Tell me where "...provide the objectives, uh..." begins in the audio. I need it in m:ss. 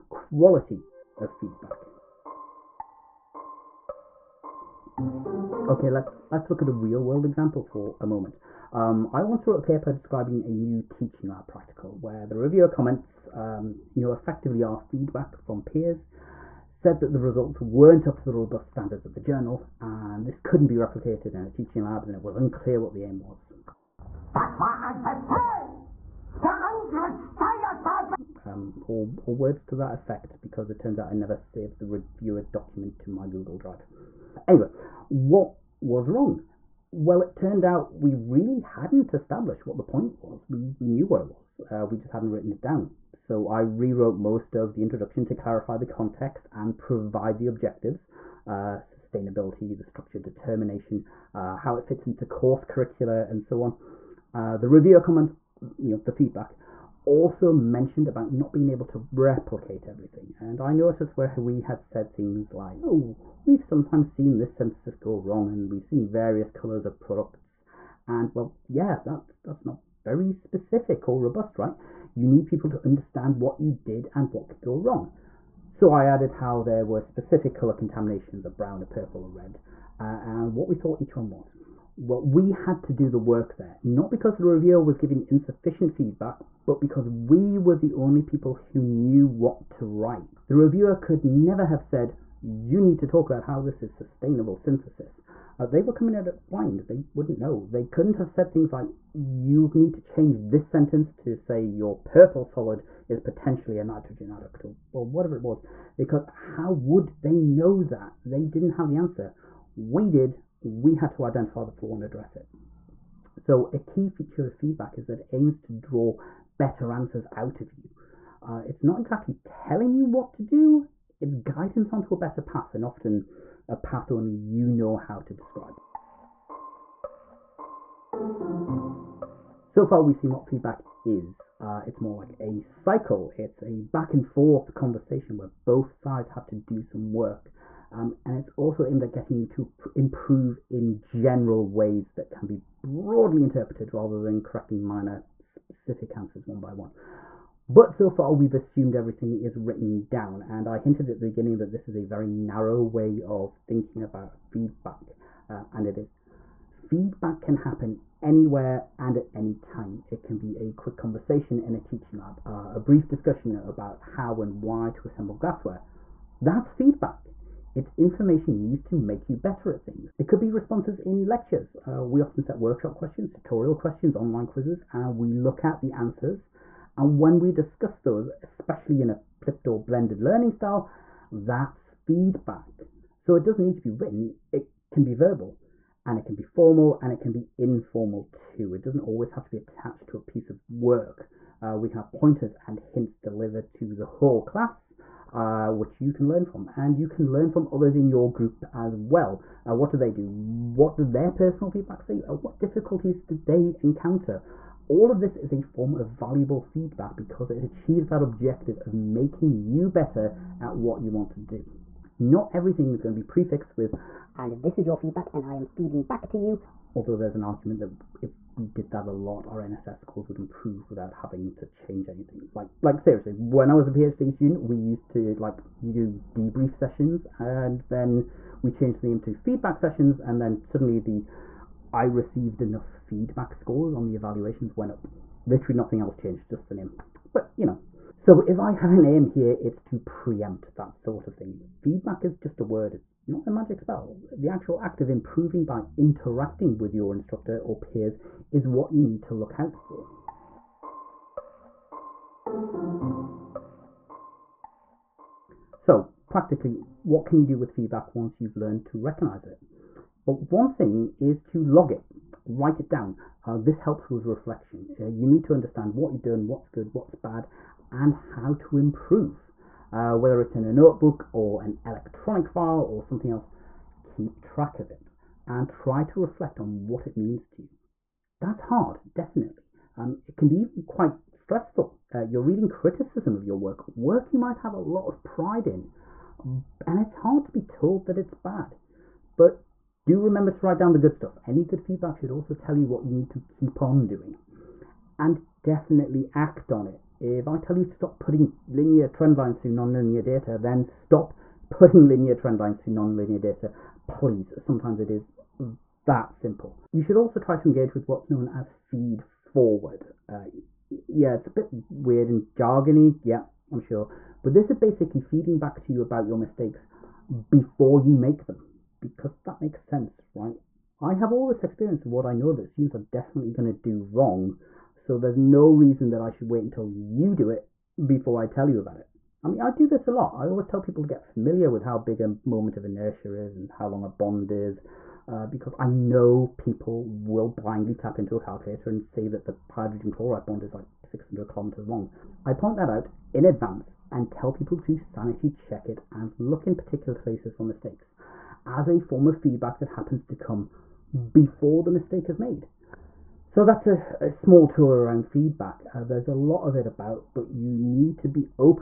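0:46.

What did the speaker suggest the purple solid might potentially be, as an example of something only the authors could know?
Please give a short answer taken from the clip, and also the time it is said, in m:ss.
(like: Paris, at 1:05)
a nitrogen adduct, at 1:43.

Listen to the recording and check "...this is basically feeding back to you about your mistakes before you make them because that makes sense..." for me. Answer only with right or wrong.
right.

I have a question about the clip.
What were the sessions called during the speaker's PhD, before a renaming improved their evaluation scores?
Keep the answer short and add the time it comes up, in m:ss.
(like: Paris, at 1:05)
debrief sessions, at 3:46.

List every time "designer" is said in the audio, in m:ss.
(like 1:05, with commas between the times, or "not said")
not said.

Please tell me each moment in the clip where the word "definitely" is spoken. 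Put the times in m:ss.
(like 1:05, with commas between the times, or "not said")
4:39, 4:55, 5:22.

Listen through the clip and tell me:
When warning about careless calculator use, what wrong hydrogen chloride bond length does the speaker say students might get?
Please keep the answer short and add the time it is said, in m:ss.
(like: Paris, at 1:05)
600 kilometers, at 5:41.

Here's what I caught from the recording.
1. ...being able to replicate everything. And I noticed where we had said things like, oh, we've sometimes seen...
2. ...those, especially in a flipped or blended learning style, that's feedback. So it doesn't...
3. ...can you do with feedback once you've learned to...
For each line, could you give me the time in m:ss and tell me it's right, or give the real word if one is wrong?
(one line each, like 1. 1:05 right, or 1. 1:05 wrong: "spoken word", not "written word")
1. 0:58 right
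2. 2:57 right
3. 4:17 right.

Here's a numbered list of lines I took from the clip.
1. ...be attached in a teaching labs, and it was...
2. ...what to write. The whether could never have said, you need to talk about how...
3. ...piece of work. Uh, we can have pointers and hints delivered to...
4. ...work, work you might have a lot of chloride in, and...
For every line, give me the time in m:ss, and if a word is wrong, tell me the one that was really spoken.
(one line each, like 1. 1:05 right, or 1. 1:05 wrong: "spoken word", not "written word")
1. 0:20 wrong: "replicated", not "attached"
2. 1:29 wrong: "reviewer", not "whether"
3. 3:10 right
4. 4:43 wrong: "pride", not "chloride".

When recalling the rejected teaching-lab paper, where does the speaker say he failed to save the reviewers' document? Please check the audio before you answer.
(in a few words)
Google Drive.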